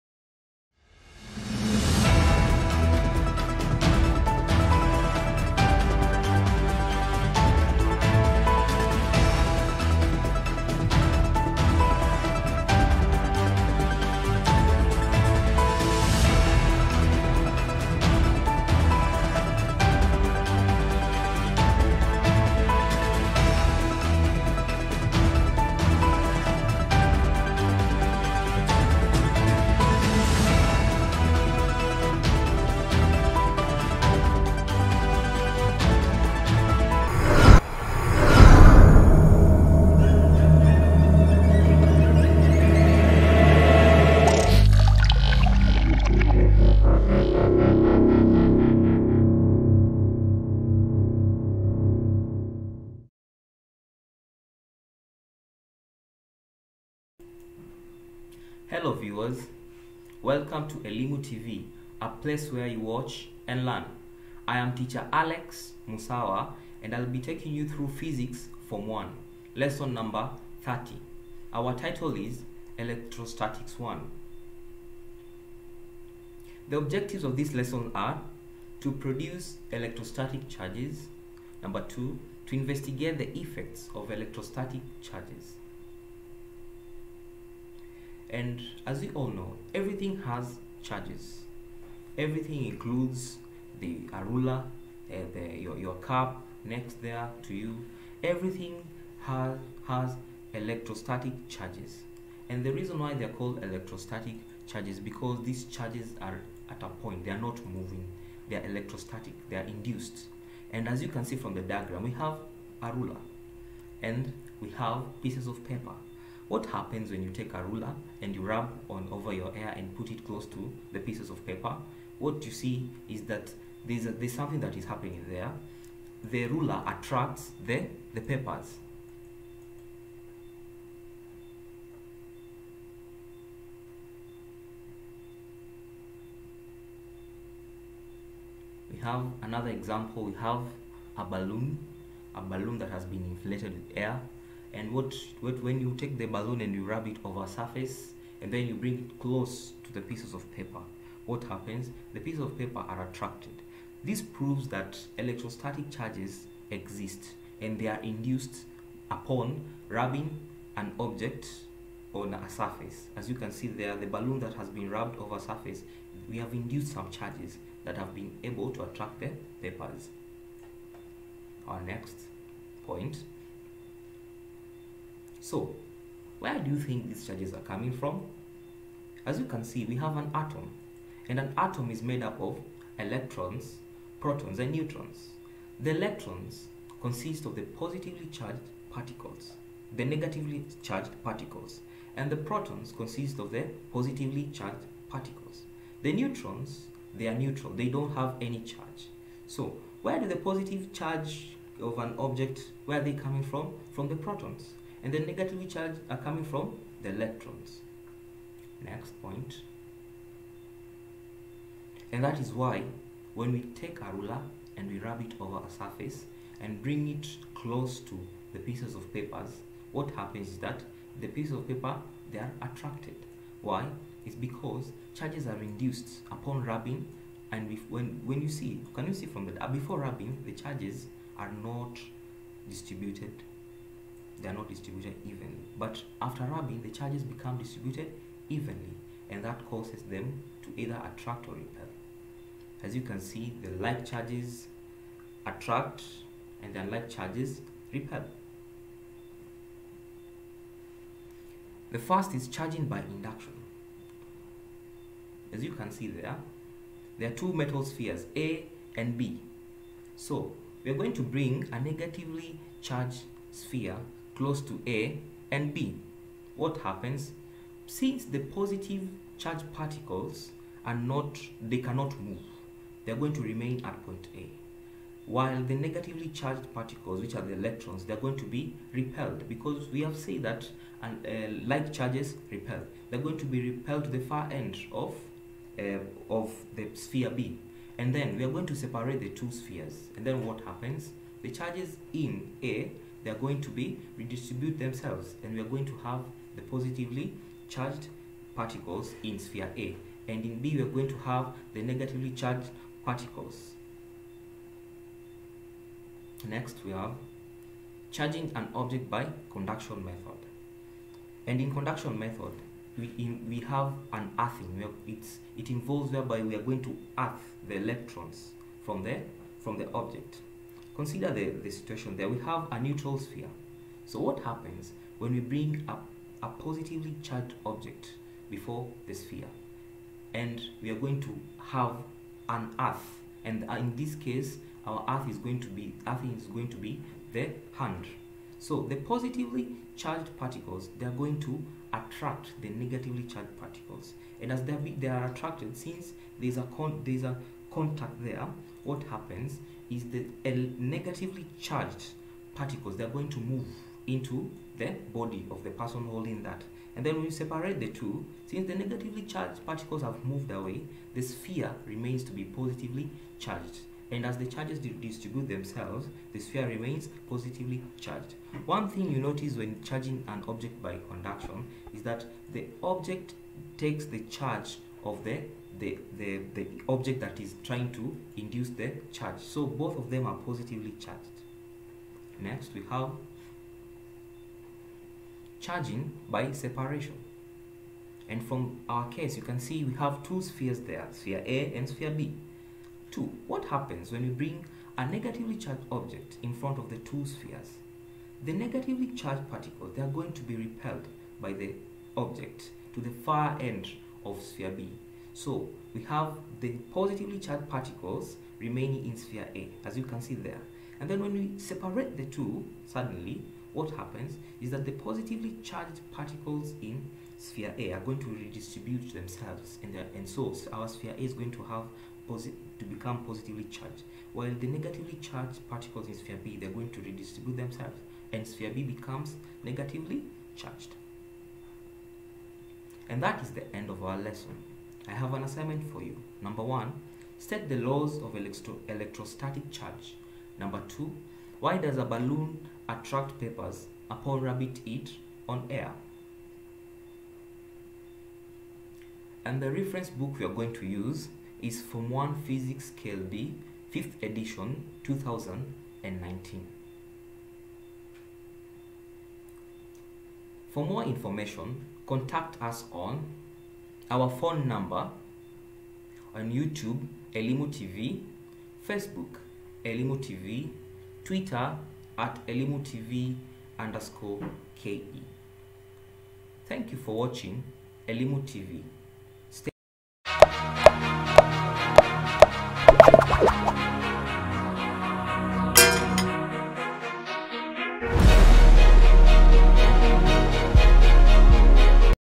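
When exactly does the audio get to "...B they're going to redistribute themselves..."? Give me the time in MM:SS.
07:06.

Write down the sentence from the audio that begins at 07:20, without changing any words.
Number two, why does a balloon attract papers upon rabbit it on air?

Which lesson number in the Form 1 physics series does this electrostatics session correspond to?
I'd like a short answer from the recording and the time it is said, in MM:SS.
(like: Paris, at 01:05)
30, at 01:10.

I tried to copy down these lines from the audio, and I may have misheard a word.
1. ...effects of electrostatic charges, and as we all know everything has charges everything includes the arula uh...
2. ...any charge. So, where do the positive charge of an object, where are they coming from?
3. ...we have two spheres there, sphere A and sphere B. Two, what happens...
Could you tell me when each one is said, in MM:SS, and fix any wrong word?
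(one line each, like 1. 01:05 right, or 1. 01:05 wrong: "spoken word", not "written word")
1. 01:23 right
2. 03:18 right
3. 06:29 right.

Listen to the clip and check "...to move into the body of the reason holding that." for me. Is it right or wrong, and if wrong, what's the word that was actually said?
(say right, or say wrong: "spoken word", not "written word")
wrong: "person", not "reason".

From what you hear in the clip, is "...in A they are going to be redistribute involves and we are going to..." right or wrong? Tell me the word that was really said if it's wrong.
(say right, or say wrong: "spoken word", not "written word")
wrong: "themselves", not "involves".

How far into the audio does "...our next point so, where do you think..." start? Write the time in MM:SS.
02:51.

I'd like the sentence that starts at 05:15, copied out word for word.
it's, it involves whereby we are going to earth the electrons from the, from the object.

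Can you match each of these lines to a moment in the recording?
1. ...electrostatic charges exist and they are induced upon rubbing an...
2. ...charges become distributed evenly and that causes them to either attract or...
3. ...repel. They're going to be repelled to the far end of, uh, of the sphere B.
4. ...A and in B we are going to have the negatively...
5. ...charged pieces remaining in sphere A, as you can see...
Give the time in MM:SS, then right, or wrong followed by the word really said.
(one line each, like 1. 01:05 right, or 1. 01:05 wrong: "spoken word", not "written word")
1. 02:35 right
2. 03:56 right
3. 04:42 right
4. 04:59 right
5. 06:47 wrong: "particles", not "pieces".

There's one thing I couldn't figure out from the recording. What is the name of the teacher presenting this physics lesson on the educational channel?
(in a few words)
Alex Musawa.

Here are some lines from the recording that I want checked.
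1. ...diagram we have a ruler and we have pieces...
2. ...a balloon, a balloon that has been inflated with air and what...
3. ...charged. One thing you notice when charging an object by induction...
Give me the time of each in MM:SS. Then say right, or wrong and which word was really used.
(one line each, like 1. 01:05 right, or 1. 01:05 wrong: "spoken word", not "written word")
1. 01:51 right
2. 02:21 right
3. 06:07 wrong: "conduction", not "induction".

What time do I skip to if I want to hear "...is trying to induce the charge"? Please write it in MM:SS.
06:17.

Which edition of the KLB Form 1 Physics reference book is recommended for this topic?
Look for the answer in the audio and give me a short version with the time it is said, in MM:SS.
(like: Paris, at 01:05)
5th edition, at 07:33.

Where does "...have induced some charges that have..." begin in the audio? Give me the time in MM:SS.
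02:46.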